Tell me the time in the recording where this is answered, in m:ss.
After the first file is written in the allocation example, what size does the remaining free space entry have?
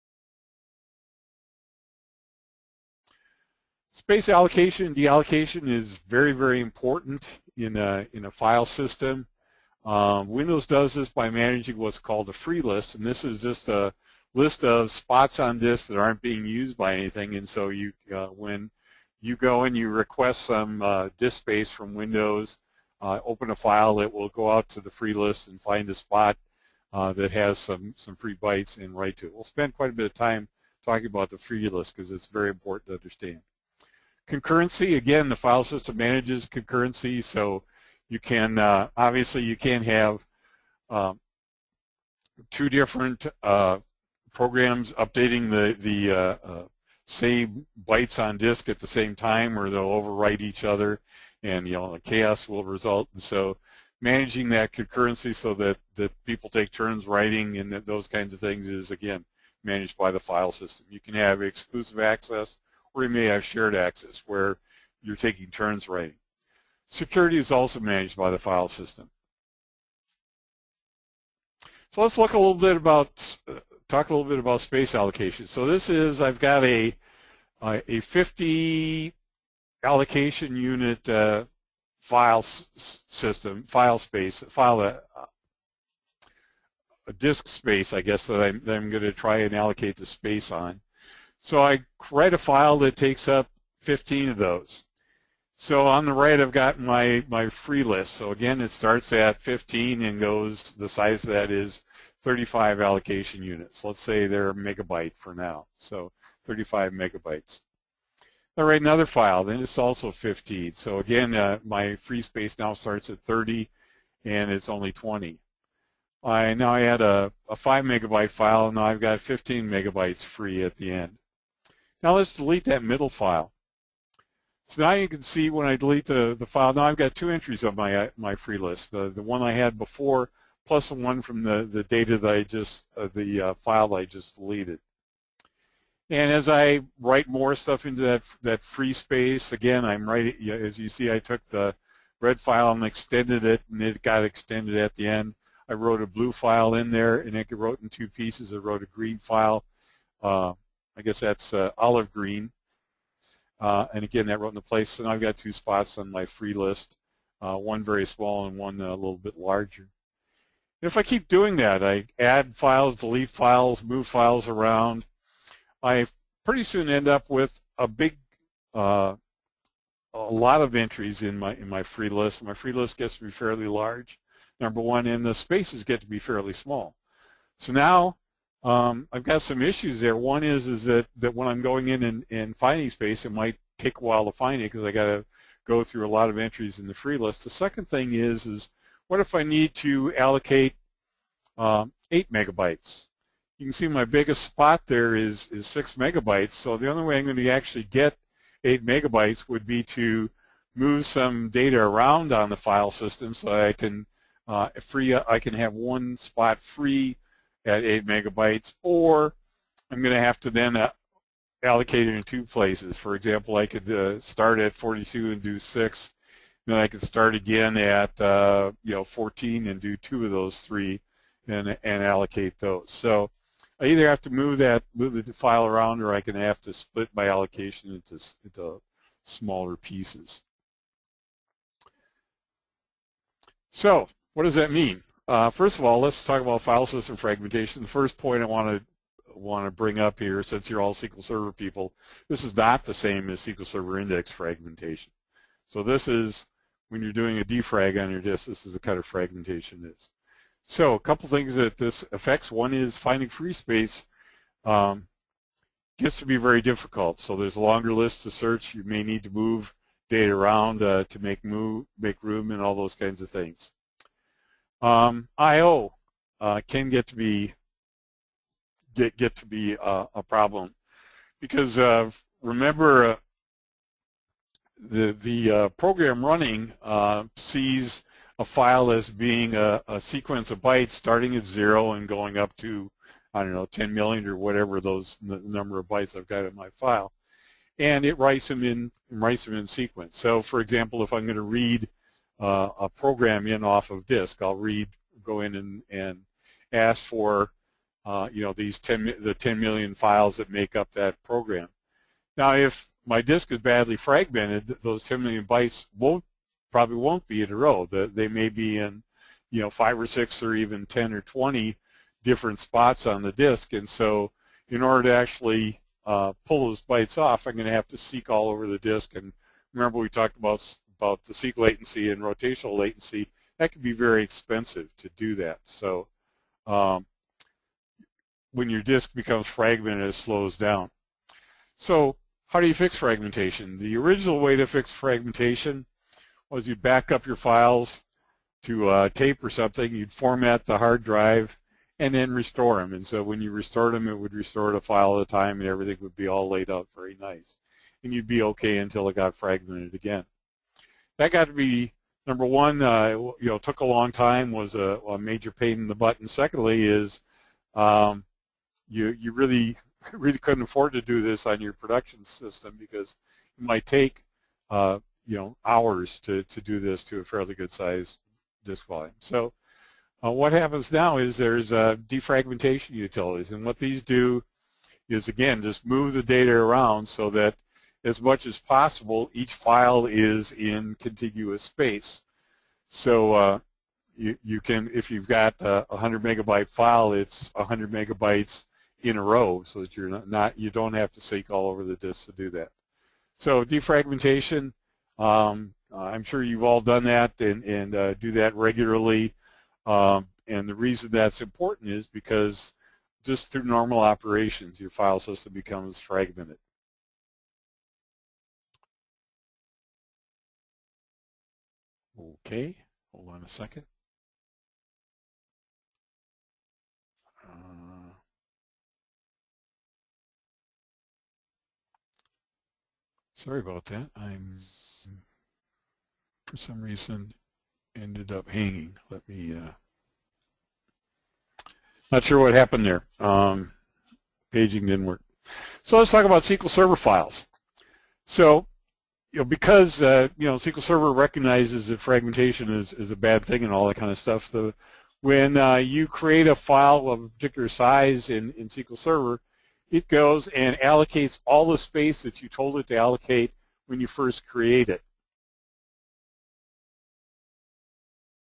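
1:42.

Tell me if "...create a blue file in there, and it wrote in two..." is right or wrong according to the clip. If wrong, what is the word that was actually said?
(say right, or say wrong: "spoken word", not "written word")
wrong: "wrote", not "create".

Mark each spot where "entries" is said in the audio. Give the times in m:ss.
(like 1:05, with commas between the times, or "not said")
2:07, 2:50, 3:06.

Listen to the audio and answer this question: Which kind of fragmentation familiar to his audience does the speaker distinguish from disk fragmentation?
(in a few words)
SQL Server index fragmentation.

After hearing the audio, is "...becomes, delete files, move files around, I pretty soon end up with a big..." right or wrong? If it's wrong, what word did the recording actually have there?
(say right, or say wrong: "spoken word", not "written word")
wrong: "files", not "becomes".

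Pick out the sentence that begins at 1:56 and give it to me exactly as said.
I now I had a, a 5 megabyte file and now I've got 15 megabytes free at the end.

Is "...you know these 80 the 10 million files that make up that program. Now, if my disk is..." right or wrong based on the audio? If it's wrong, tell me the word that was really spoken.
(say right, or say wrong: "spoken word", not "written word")
wrong: "10", not "80".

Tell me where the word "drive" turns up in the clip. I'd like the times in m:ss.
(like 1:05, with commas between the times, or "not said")
5:41.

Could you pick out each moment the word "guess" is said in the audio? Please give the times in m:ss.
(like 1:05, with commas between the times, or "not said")
1:28, 2:31.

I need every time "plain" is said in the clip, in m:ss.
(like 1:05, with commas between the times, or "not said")
not said.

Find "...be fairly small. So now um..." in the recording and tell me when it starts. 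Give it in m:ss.
2:56.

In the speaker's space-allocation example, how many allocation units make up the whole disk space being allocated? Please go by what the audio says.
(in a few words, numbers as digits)
50.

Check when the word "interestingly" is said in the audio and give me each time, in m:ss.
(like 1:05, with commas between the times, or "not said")
not said.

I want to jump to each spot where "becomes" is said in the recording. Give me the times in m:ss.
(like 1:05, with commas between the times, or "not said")
5:29, 6:45.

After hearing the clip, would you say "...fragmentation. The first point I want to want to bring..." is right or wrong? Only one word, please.
right.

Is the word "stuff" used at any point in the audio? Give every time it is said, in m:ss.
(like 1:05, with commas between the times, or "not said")
2:17, 7:24.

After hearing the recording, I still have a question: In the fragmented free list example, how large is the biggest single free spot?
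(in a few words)
6 megabytes.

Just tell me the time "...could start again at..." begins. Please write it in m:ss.
3:36.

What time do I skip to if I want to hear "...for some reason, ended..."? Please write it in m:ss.
7:06.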